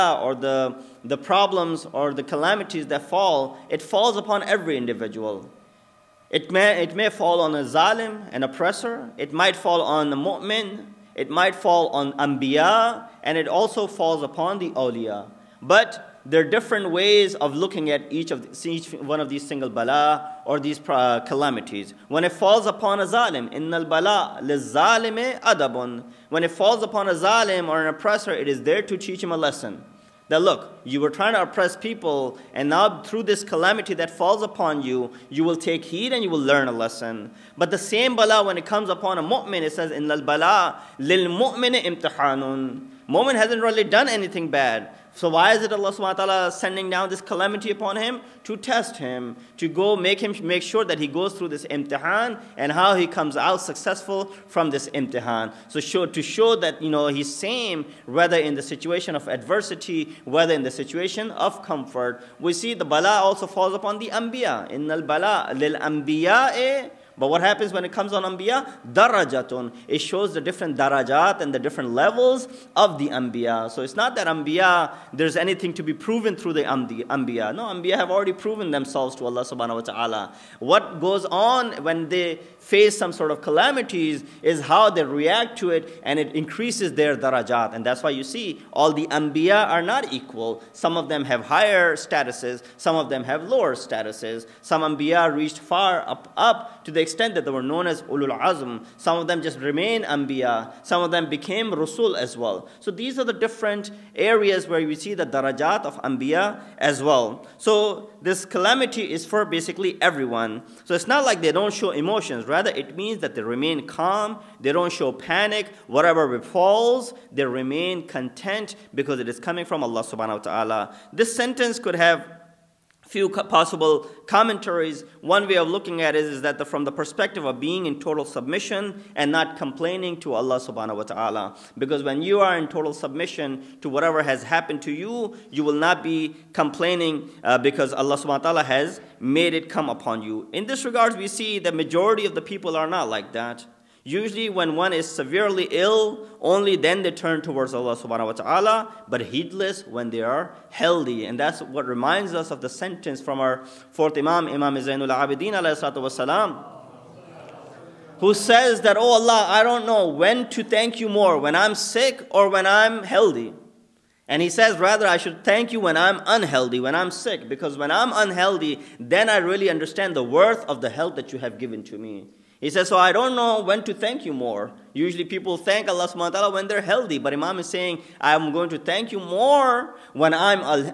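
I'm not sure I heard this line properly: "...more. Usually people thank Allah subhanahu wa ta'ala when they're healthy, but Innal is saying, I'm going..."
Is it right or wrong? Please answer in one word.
wrong.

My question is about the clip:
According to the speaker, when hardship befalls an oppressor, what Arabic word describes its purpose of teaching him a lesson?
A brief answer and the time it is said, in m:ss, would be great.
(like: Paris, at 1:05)
adabun, at 0:25.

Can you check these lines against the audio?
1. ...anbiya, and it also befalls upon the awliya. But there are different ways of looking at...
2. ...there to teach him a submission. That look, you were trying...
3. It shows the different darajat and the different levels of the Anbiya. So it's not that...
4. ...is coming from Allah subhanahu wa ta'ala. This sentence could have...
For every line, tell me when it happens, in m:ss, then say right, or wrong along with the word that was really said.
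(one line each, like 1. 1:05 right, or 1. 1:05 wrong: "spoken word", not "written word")
1. 0:12 wrong: "falls", not "befalls"
2. 0:28 wrong: "lesson", not "submission"
3. 1:09 right
4. 1:59 right.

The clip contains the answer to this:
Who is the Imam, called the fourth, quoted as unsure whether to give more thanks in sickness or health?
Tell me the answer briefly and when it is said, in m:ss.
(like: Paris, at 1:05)
Imam Zainul Abidin, at 2:34.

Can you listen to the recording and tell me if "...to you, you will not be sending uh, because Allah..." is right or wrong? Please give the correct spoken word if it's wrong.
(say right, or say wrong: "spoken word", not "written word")
wrong: "complaining", not "sending".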